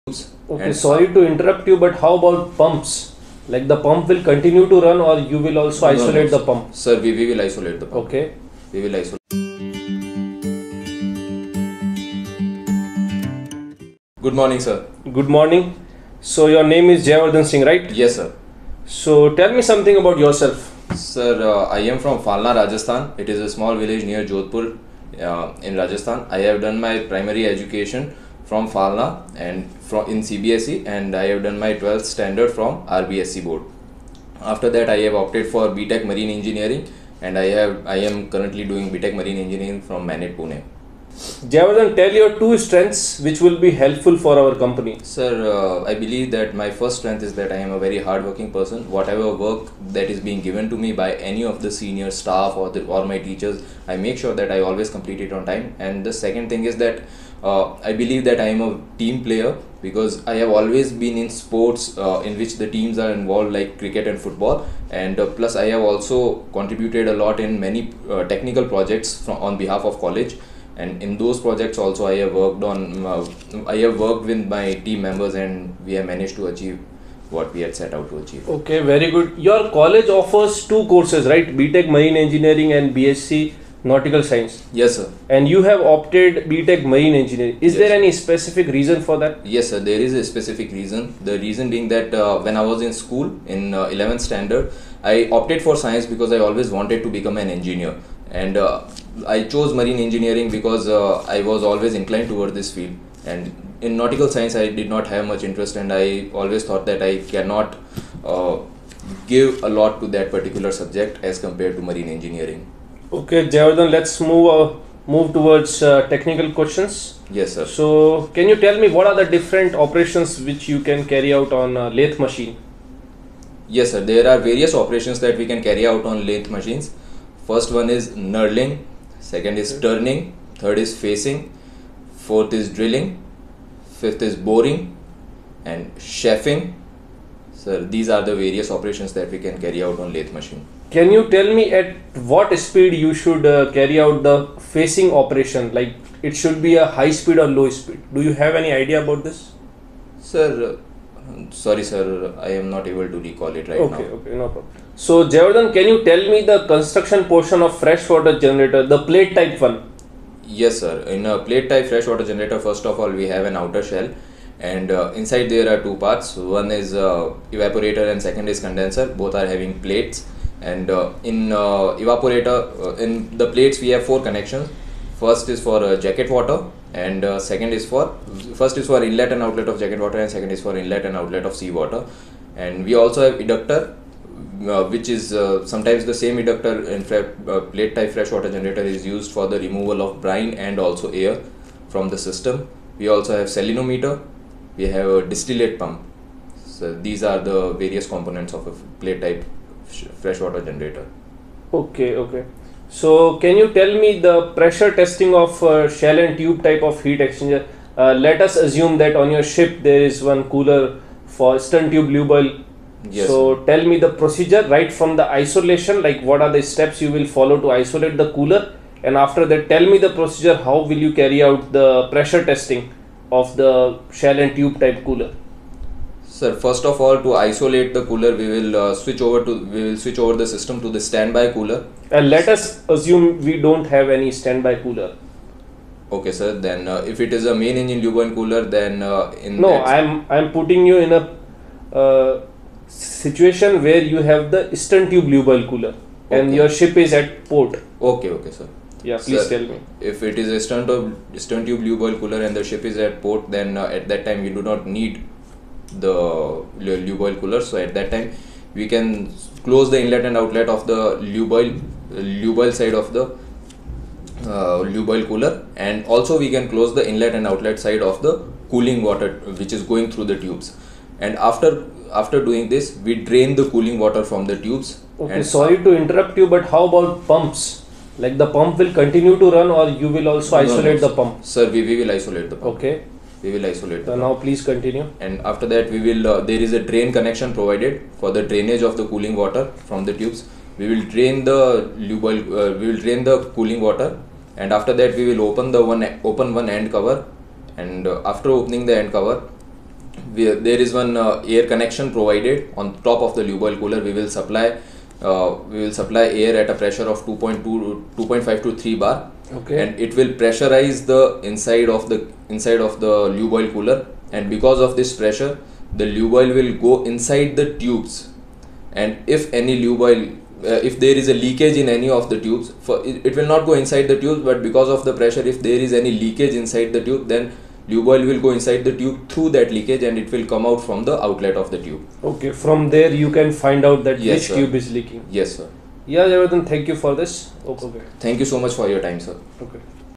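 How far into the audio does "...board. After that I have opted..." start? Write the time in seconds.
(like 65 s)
33 s.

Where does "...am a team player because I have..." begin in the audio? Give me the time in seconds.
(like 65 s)
58 s.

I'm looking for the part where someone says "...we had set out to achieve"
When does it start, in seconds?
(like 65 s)
77 s.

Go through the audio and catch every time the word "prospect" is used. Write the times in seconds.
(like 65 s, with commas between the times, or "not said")
not said.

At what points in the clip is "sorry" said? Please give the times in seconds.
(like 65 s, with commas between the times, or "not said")
0 s, 151 s, 275 s.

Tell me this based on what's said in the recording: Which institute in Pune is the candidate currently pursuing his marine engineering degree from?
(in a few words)
MANET.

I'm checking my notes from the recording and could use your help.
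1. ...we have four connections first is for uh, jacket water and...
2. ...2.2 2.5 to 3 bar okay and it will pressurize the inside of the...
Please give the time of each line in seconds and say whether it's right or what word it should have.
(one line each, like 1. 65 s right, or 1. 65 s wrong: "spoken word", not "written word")
1. 173 s right
2. 307 s right.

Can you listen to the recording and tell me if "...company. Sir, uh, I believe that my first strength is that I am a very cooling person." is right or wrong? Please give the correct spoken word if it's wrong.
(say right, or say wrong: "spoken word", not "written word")
wrong: "hardworking", not "cooling".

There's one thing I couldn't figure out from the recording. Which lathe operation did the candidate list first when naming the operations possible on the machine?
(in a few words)
Knurling.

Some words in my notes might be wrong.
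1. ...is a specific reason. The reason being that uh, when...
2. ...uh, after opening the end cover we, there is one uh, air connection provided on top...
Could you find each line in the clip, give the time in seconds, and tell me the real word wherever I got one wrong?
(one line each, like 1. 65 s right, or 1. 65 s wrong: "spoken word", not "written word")
1. 90 s right
2. 298 s right.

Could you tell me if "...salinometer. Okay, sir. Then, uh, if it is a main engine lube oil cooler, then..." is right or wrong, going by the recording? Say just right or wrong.
wrong.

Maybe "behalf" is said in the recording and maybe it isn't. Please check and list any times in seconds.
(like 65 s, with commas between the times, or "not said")
69 s.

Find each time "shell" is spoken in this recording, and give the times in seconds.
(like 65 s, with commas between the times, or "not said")
163 s, 205 s, 224 s.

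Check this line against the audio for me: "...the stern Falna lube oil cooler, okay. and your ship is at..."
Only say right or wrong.
wrong.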